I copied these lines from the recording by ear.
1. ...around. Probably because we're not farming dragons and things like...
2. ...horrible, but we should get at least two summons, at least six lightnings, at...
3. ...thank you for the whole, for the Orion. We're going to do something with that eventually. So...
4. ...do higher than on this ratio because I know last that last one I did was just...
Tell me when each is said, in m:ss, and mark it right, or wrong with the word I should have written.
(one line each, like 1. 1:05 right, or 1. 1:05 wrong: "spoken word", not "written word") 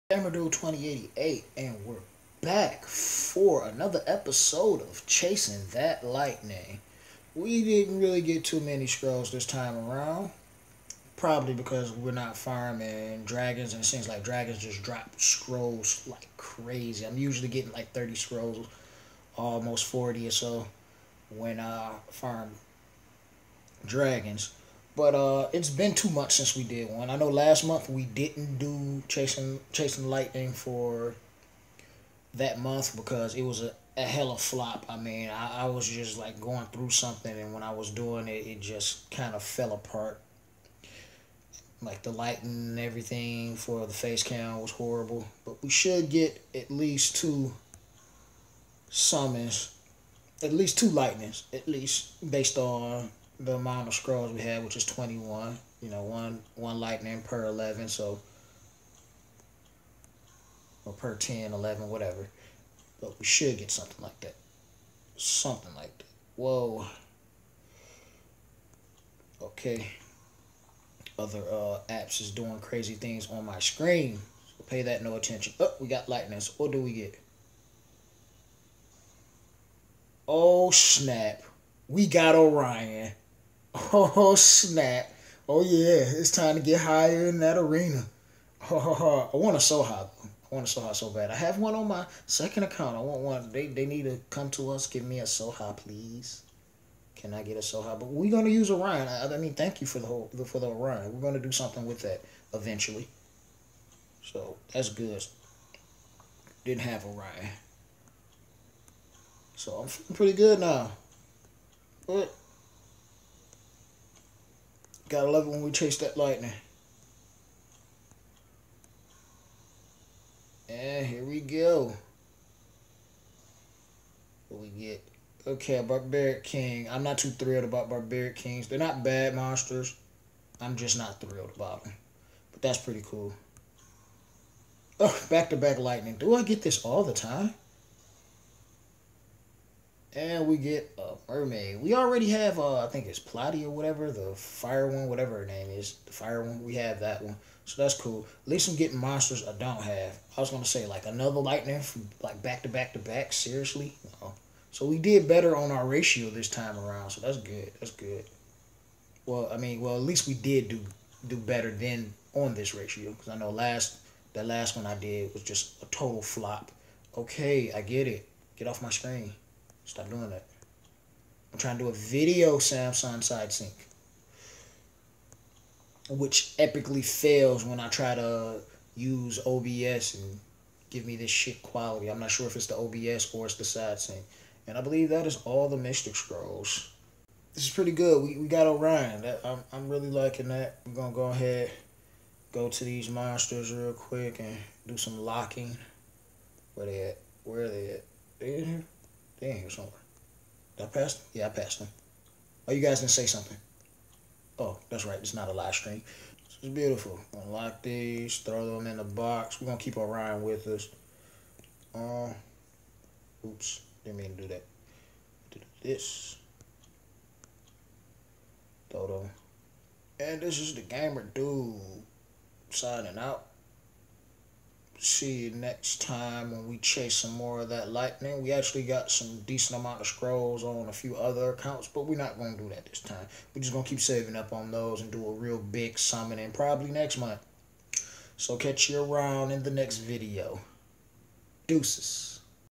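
1. 0:09 right
2. 0:44 wrong: "two", not "six"
3. 1:39 right
4. 2:41 wrong: "better", not "higher".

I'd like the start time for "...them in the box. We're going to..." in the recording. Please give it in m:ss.
3:28.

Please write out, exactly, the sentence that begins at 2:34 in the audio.
so we did better on our ratio this time around.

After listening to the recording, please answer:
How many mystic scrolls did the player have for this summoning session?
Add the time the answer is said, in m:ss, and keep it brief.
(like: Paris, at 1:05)
21, at 0:54.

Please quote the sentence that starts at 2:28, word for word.
At least I'm getting monsters I don't have.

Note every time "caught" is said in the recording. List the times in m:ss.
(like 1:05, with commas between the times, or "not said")
not said.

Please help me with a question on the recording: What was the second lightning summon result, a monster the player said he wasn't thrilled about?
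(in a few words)
Barbaric King.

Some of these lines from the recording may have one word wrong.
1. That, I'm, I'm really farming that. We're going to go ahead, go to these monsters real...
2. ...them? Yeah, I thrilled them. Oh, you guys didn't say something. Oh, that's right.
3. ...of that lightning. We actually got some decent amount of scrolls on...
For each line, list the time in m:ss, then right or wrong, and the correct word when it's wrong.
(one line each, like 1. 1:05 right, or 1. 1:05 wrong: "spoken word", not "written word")
1. 3:09 wrong: "liking", not "farming"
2. 3:21 wrong: "passed", not "thrilled"
3. 3:47 right.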